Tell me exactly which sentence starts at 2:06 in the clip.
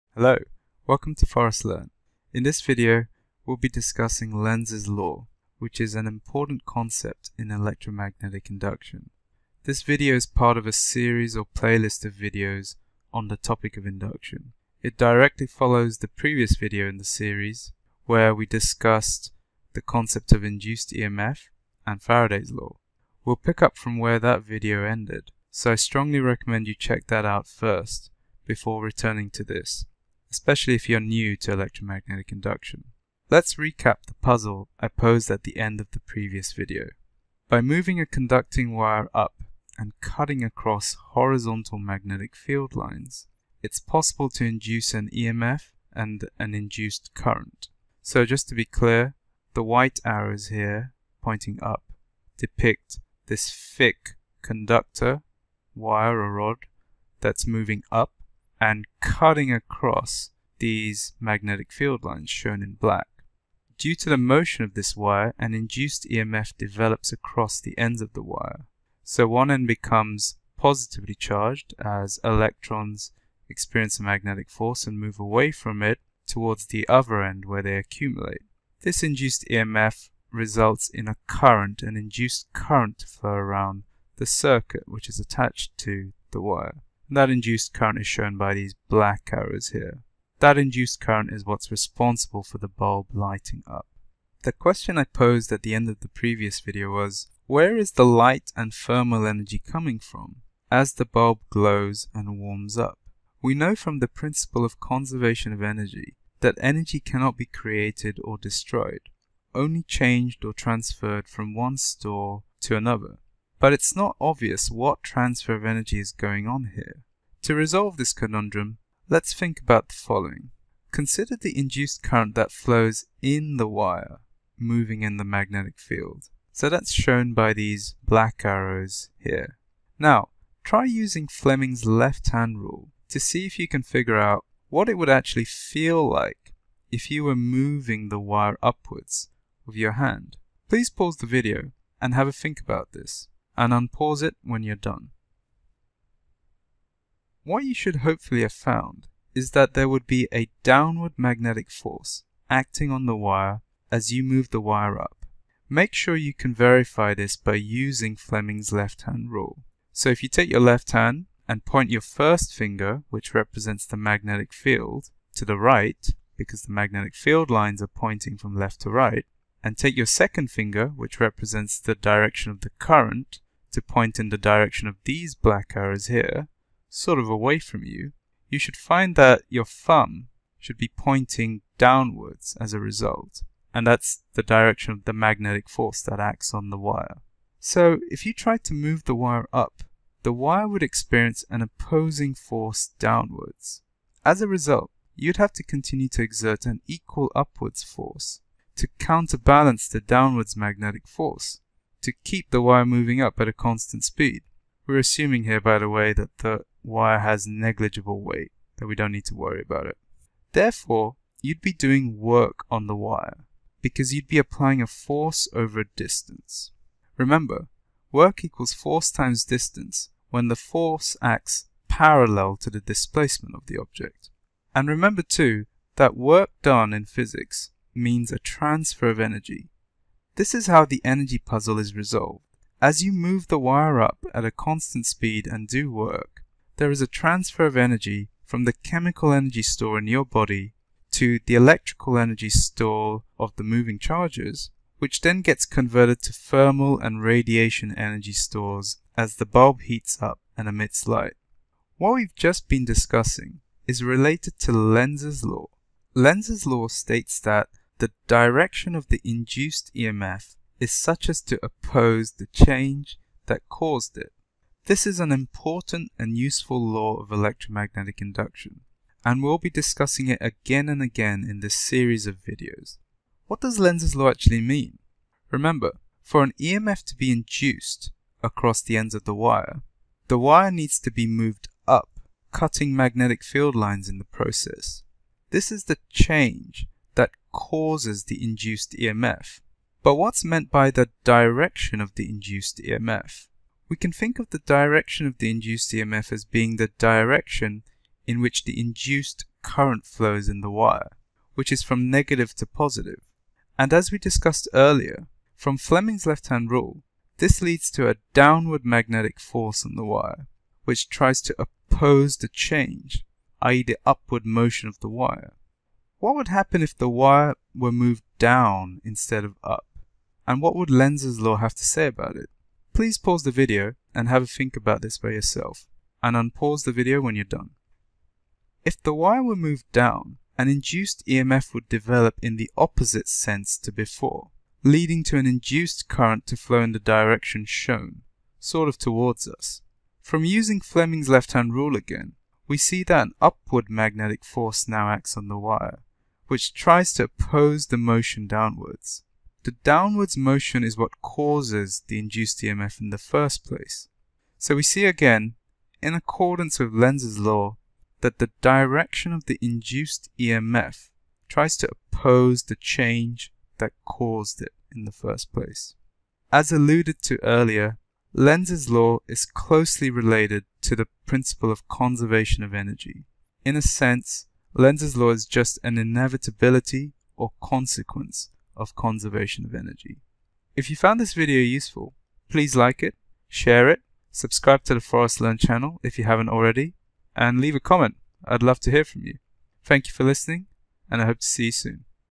So that's shown by these black arrows here.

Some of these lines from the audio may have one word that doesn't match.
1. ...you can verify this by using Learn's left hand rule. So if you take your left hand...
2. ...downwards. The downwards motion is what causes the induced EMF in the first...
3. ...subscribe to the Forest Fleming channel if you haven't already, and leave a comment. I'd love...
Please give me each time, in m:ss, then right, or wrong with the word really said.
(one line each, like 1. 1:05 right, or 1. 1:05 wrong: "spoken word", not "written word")
1. 2:36 wrong: "Fleming", not "Learn"
2. 5:48 right
3. 6:24 wrong: "Learn", not "Fleming".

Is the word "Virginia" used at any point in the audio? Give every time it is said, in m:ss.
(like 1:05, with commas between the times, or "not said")
not said.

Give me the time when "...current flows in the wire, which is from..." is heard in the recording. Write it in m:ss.
4:59.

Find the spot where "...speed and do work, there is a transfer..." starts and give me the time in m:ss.
3:55.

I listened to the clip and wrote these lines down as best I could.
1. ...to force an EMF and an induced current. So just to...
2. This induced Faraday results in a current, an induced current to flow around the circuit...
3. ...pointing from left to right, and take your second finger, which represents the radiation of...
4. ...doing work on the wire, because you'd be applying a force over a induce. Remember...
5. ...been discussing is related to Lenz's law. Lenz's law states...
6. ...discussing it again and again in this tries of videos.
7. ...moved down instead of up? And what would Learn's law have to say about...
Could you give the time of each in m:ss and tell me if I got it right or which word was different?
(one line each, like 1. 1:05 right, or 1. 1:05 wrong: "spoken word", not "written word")
1. 0:44 wrong: "induce", not "force"
2. 1:18 wrong: "EMF", not "Faraday"
3. 2:47 wrong: "direction", not "radiation"
4. 3:31 wrong: "distance", not "induce"
5. 4:12 right
6. 4:29 wrong: "series", not "tries"
7. 5:17 wrong: "Lenz", not "Learn".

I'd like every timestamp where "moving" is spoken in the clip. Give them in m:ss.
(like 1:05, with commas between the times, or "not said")
0:37, 0:57, 2:04, 2:17, 3:22, 4:03.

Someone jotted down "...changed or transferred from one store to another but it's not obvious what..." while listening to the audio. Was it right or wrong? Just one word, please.
right.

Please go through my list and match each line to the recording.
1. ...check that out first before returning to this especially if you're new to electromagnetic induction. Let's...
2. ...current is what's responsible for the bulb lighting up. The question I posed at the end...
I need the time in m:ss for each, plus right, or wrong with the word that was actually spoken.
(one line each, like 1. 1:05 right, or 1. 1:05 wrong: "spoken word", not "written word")
1. 0:26 right
2. 1:31 right.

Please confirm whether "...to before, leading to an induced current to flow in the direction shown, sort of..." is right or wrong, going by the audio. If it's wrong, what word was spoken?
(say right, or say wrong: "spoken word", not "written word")
right.